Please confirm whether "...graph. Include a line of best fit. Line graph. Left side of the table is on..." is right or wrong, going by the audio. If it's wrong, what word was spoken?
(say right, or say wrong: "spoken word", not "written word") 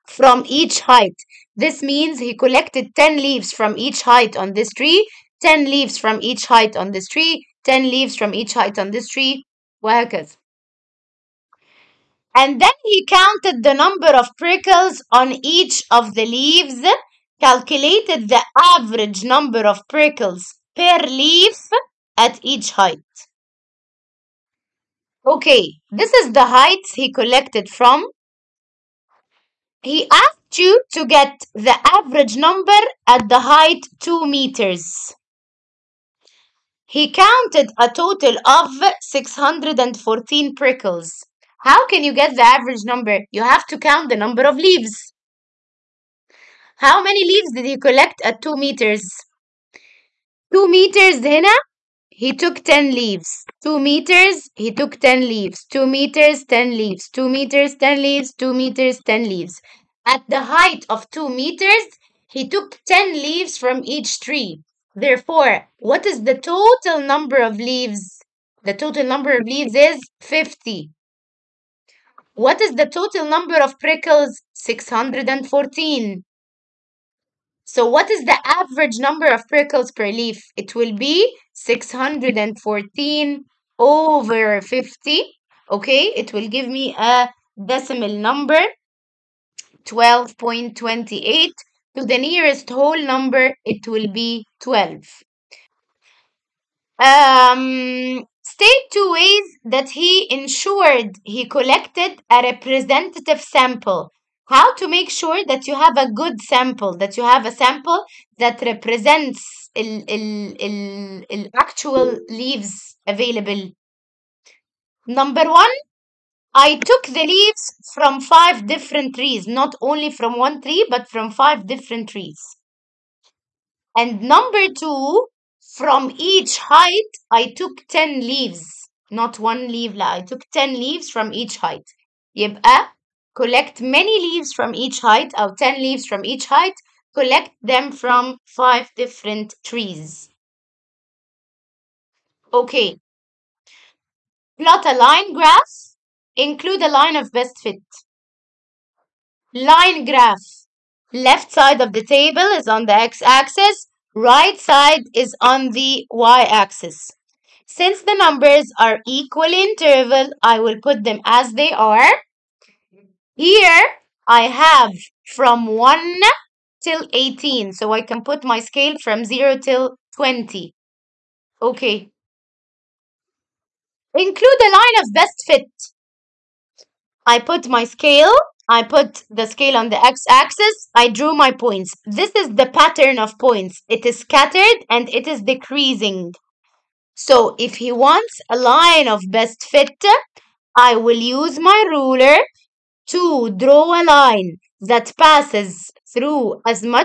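right.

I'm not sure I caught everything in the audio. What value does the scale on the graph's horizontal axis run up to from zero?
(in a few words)
20.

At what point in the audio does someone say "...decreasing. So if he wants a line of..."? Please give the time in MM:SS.
03:05.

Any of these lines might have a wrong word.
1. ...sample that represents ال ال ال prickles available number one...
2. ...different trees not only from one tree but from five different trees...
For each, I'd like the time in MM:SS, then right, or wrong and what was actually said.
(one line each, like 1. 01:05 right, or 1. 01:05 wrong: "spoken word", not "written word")
1. 01:47 wrong: "leaves", not "prickles"
2. 01:58 right.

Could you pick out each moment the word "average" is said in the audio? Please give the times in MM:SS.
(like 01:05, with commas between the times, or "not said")
00:18, 00:31, 00:42, 01:18.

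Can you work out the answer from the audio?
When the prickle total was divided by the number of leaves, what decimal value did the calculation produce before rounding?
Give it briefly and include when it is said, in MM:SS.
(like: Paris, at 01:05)
12.28, at 01:29.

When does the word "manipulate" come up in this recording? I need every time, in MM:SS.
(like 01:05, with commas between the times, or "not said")
not said.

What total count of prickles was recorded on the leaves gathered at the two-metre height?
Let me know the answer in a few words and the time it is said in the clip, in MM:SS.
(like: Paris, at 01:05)
614, at 00:39.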